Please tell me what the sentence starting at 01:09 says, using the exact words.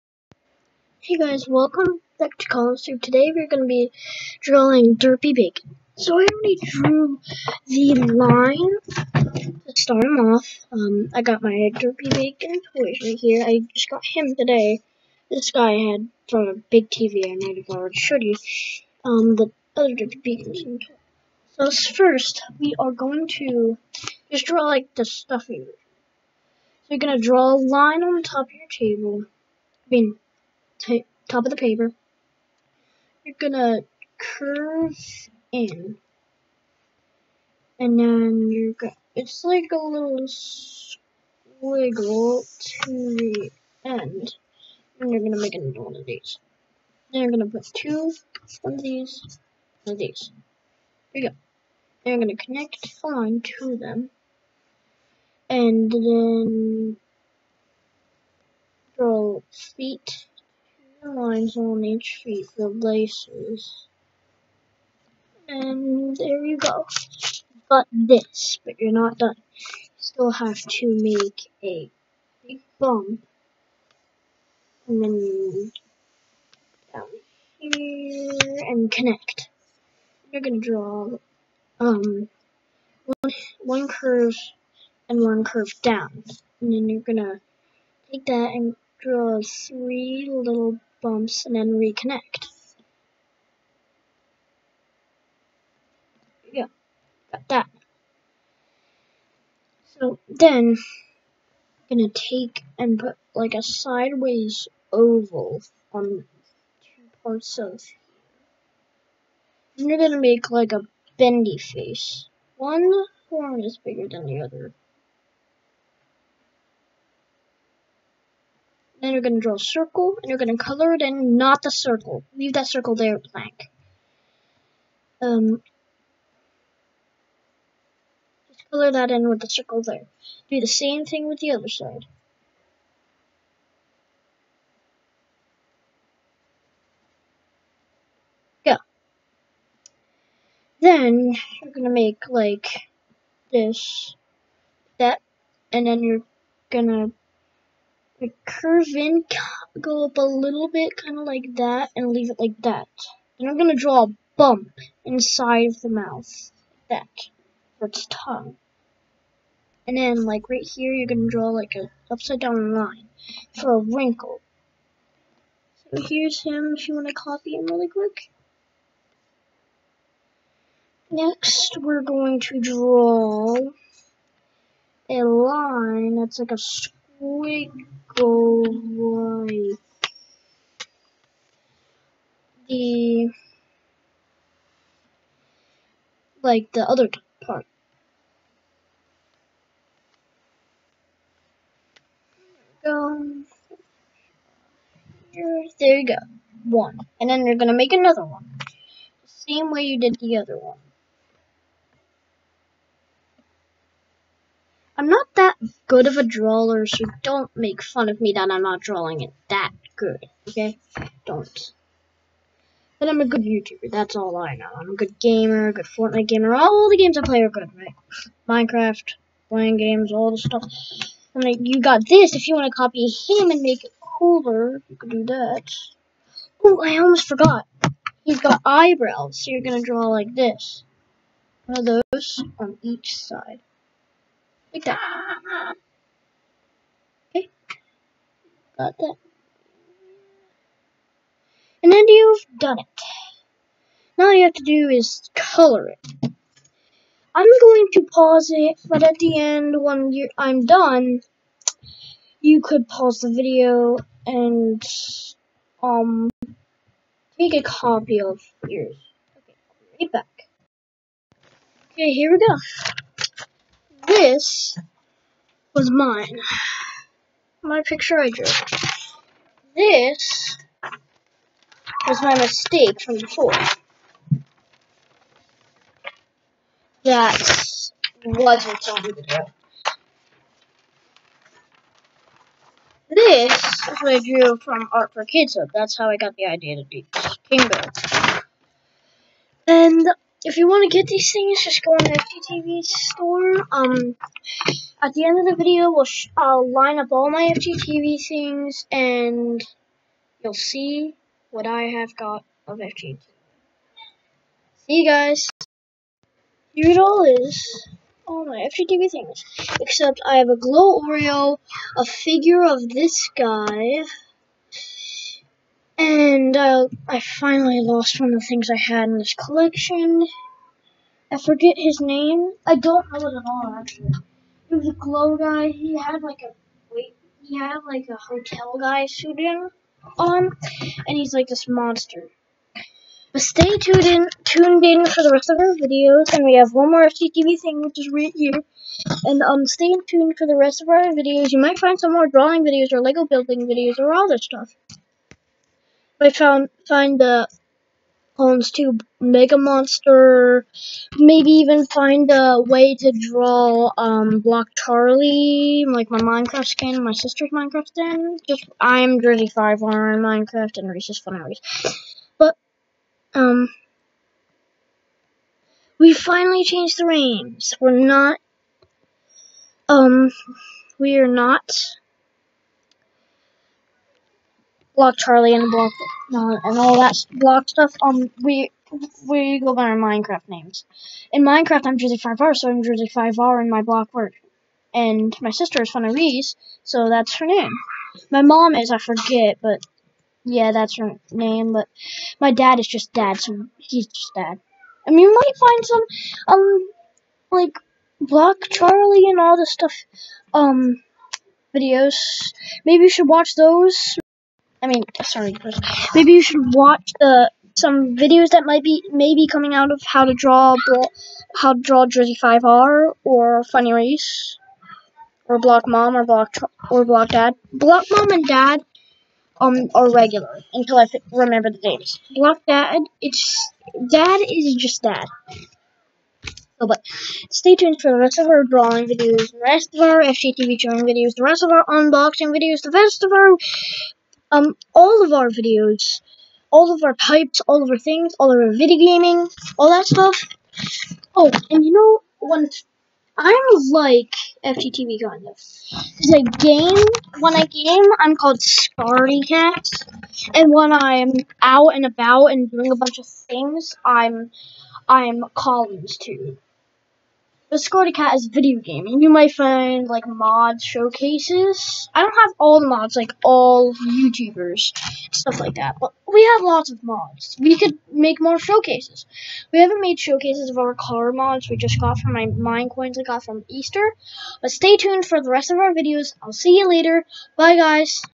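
You still have to make a big bump.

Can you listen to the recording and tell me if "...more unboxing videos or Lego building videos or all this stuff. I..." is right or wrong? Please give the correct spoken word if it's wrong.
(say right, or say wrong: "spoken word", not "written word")
wrong: "drawing", not "unboxing".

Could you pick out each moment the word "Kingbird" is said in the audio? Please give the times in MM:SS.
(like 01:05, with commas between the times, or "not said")
04:47.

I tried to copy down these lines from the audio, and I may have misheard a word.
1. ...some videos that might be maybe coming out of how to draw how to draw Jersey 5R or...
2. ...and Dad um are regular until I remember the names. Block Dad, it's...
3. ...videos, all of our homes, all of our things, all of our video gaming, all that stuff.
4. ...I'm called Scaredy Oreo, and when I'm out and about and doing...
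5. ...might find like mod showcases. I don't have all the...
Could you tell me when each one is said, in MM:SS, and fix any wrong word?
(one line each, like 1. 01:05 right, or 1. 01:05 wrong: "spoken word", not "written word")
1. 06:47 right
2. 06:58 right
3. 07:15 wrong: "types", not "homes"
4. 07:28 wrong: "Cat", not "Oreo"
5. 07:39 right.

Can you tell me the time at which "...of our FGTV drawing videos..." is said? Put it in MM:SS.
07:09.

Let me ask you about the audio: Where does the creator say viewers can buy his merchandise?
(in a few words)
FGTV store.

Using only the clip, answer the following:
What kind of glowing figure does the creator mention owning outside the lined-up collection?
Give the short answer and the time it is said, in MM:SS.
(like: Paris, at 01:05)
Glow Oreo, at 05:10.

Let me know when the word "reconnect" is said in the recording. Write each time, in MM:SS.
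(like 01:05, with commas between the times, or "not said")
01:31.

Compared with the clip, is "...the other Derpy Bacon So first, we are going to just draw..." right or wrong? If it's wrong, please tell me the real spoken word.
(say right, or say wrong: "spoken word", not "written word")
right.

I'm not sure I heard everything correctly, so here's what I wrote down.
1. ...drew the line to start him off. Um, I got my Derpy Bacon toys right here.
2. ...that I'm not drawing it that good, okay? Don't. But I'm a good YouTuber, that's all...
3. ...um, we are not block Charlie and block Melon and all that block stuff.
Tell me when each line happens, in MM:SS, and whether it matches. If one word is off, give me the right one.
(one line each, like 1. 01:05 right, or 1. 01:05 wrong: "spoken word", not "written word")
1. 00:06 right
2. 03:28 right
3. 06:09 right.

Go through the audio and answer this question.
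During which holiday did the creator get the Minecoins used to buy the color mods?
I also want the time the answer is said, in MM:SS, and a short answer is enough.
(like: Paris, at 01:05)
Easter, at 07:53.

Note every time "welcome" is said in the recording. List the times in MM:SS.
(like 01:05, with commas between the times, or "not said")
00:01.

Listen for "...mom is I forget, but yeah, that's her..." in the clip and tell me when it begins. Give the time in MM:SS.
06:28.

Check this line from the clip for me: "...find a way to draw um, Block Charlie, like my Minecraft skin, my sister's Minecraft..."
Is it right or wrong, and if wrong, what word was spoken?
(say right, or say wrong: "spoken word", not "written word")
right.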